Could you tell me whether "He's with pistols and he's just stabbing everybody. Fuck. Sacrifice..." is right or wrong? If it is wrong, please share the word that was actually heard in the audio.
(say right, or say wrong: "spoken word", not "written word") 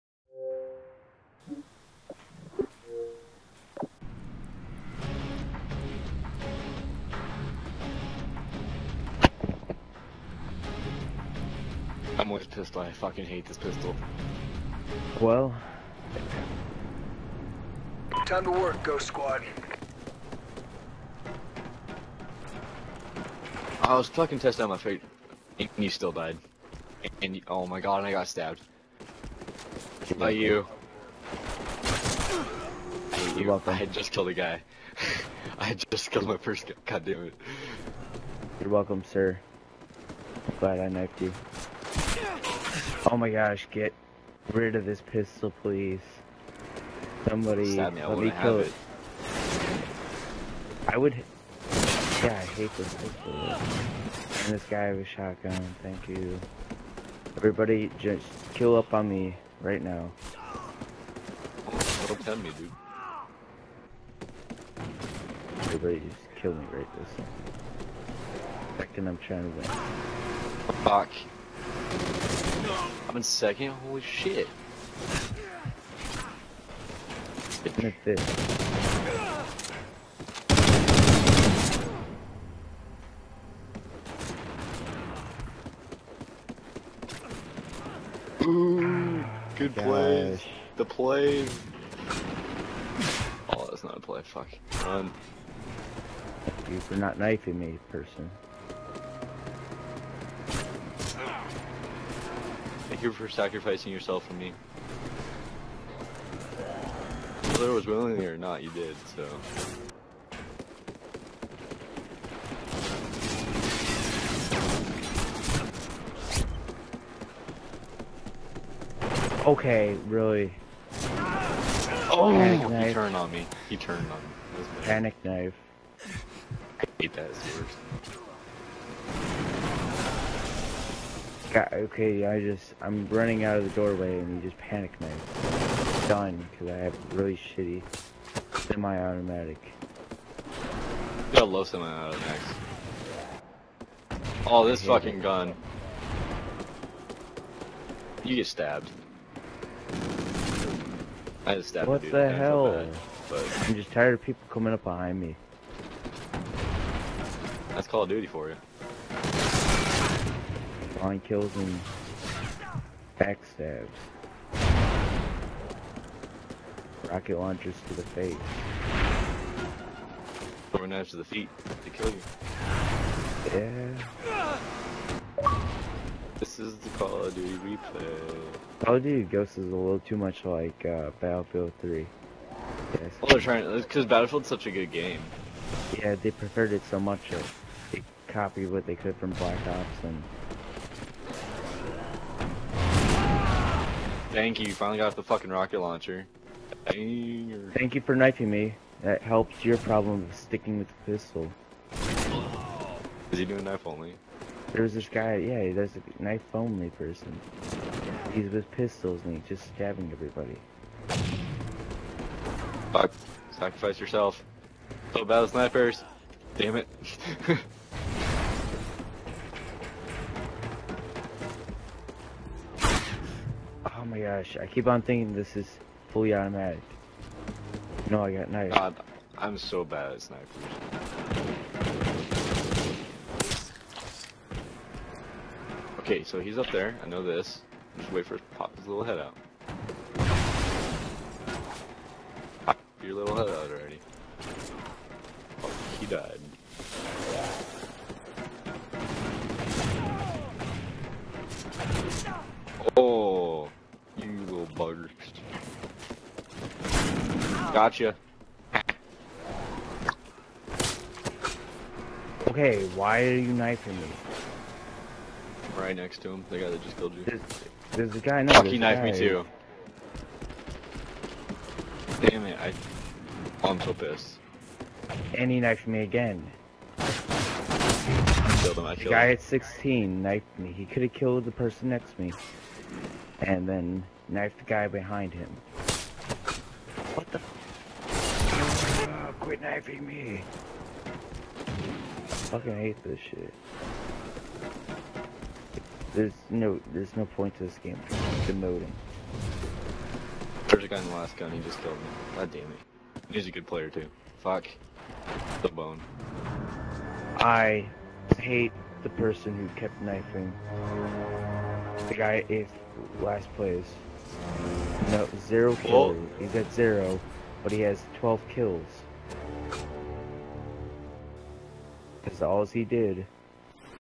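right.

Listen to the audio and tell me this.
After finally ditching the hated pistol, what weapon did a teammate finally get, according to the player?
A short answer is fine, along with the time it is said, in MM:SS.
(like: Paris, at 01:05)
rocket launcher, at 03:15.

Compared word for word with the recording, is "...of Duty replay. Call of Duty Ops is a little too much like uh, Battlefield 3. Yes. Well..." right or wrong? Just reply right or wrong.
wrong.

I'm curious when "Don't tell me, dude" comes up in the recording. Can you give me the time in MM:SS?
01:02.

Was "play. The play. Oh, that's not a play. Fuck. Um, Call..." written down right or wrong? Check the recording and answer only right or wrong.
wrong.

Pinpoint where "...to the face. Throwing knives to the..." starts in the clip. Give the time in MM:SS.
02:47.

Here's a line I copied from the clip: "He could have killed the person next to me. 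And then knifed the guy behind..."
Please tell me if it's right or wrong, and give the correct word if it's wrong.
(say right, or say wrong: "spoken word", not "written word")
right.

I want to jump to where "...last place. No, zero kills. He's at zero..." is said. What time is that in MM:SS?
05:13.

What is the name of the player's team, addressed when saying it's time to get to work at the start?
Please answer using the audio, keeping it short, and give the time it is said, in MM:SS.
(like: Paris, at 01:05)
Ghost Squad, at 00:18.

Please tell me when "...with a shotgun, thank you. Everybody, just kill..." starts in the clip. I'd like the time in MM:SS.
00:54.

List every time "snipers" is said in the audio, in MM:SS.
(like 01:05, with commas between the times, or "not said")
03:35, 03:50.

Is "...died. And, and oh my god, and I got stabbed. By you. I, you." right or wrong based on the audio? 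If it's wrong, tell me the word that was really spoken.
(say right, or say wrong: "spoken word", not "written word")
right.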